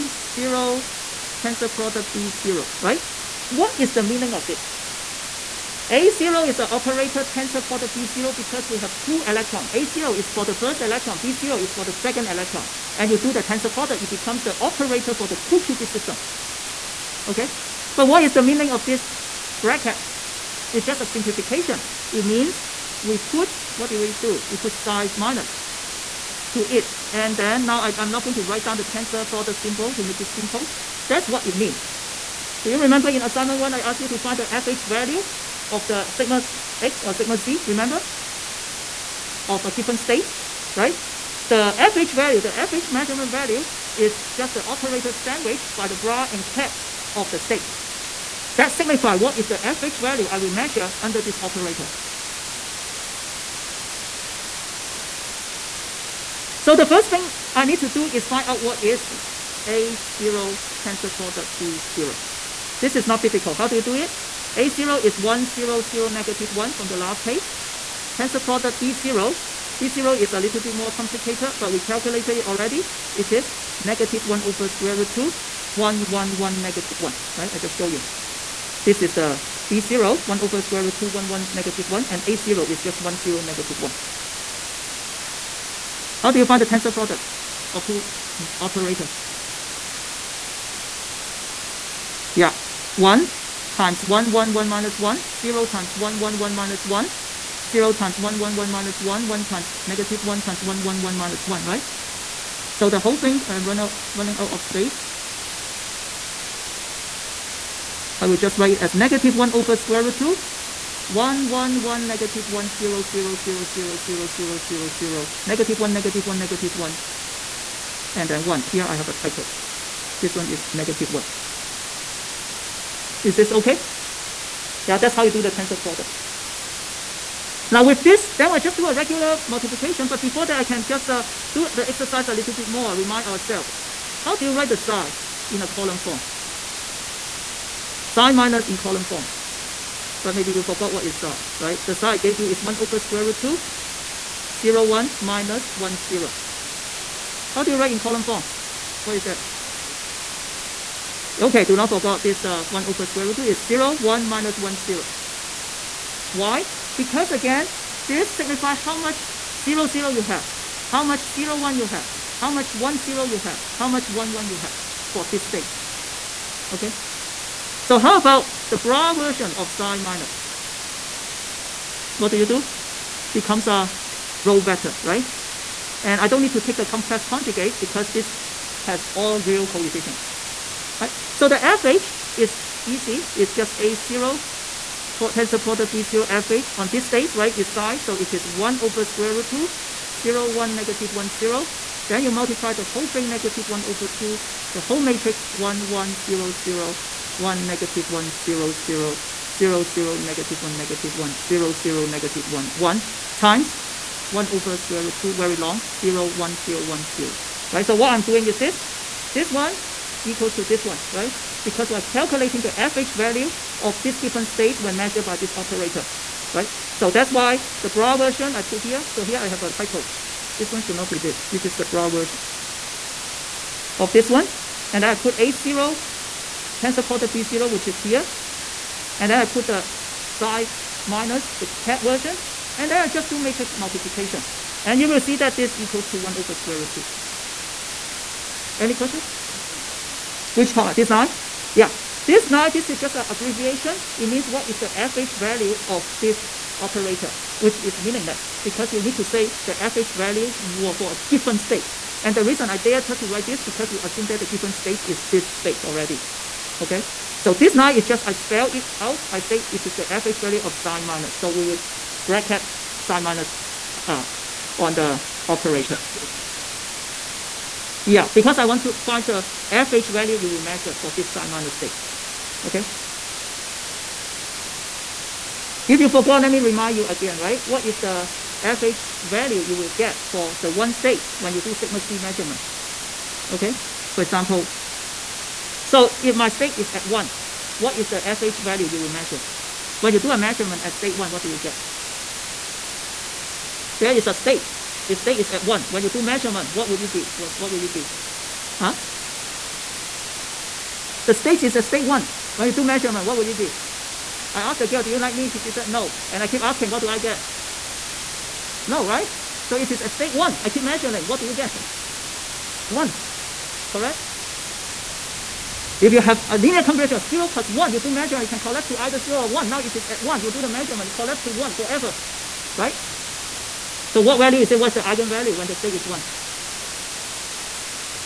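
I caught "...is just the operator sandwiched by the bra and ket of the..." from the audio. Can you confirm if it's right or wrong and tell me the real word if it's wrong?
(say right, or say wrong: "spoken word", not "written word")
right.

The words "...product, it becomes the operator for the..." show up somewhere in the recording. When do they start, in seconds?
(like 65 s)
13 s.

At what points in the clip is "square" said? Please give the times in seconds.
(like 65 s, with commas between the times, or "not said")
74 s, 80 s, 109 s, 142 s, 153 s, 189 s, 204 s, 236 s.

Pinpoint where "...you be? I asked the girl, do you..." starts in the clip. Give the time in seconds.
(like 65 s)
303 s.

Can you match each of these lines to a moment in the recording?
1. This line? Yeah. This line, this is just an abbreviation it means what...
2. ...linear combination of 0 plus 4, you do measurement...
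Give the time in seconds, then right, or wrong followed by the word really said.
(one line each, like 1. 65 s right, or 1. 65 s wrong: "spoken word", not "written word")
1. 240 s right
2. 316 s wrong: "1", not "4".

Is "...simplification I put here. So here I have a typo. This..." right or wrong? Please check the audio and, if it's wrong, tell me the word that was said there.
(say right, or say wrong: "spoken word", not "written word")
wrong: "version", not "simplification".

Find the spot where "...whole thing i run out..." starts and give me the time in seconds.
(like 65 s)
102 s.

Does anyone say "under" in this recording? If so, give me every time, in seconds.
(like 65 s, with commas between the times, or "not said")
51 s.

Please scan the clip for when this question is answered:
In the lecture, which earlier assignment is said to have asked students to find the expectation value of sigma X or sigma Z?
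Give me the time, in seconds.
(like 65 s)
33 s.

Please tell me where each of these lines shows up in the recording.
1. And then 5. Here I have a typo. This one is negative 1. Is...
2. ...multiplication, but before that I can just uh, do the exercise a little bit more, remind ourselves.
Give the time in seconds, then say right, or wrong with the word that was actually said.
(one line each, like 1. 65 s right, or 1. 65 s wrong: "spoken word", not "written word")
1. 118 s wrong: "1", not "5"
2. 129 s right.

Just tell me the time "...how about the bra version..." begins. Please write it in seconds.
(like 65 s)
167 s.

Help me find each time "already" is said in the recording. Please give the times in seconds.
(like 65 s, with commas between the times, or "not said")
72 s, 255 s.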